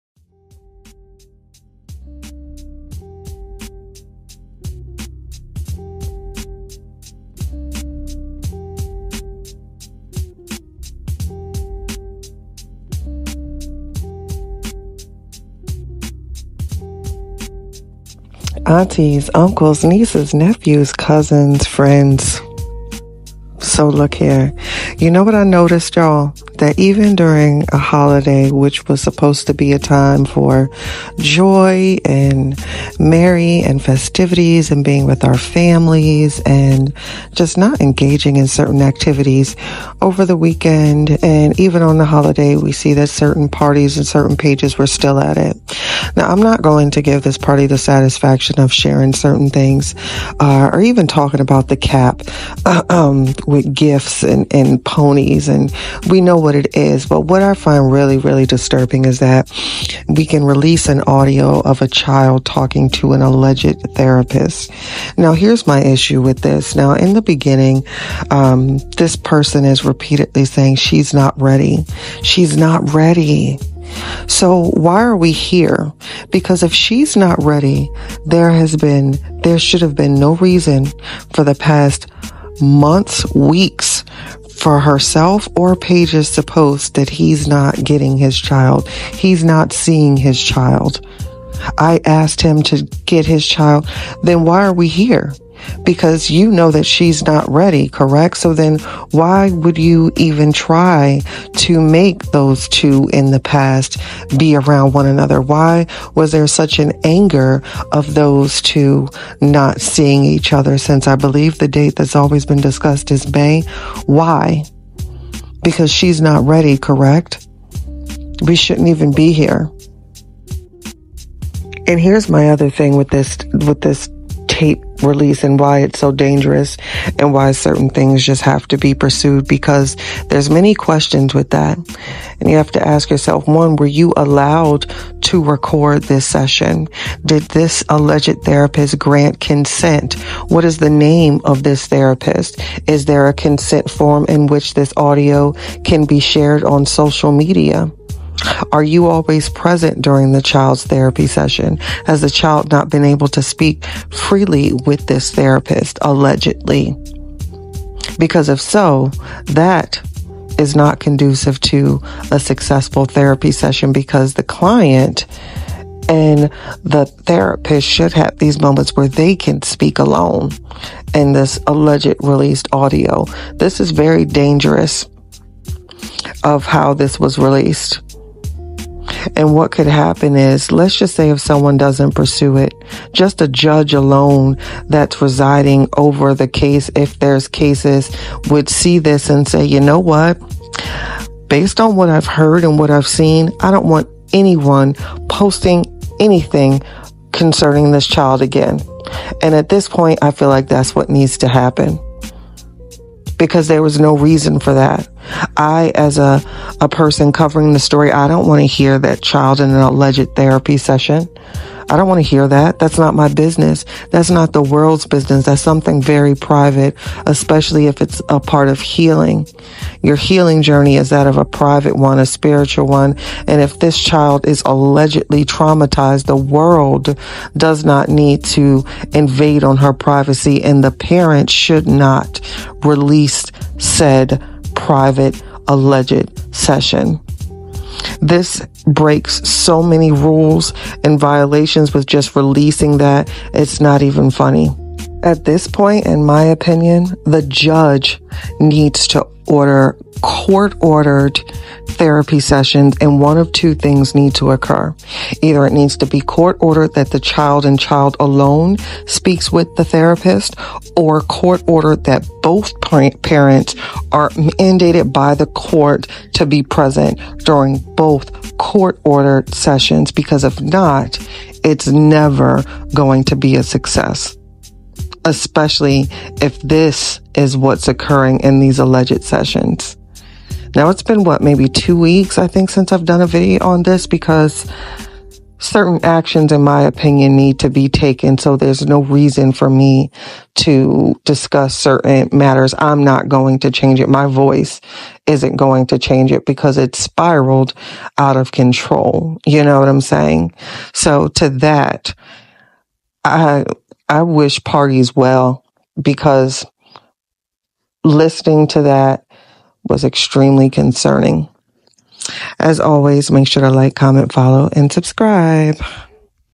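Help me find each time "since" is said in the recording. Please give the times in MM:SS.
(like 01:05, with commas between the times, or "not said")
01:50, 04:42.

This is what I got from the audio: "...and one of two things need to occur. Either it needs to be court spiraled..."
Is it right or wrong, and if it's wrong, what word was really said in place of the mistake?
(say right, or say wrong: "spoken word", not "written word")
wrong: "ordered", not "spiraled".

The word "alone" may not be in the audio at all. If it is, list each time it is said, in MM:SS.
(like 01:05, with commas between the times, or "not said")
02:49, 03:03, 04:18.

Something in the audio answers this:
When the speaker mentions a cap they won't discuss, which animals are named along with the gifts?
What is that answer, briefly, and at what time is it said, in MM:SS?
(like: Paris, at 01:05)
ponies, at 00:54.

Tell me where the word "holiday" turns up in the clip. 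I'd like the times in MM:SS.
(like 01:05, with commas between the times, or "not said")
00:27, 00:42.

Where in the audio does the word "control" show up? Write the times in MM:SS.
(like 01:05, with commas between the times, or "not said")
04:58.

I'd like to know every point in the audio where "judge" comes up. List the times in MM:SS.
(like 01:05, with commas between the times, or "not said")
03:03, 04:07.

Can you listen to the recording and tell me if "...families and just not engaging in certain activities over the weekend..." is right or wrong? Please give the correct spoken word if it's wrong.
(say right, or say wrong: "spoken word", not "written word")
right.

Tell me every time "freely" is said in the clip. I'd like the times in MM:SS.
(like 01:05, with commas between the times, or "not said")
02:34.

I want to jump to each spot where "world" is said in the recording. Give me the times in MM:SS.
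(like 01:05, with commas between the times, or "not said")
03:34, 03:46.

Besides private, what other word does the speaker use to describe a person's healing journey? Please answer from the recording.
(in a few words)
spiritual.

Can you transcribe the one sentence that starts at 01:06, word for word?
Now, in the beginning, um, this person is repeatedly saying she's not ready.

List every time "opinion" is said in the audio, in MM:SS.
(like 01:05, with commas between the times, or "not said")
04:06, 04:46.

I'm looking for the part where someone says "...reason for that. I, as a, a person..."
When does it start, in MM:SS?
03:24.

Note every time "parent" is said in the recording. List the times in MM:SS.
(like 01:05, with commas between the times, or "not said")
03:50, 04:23.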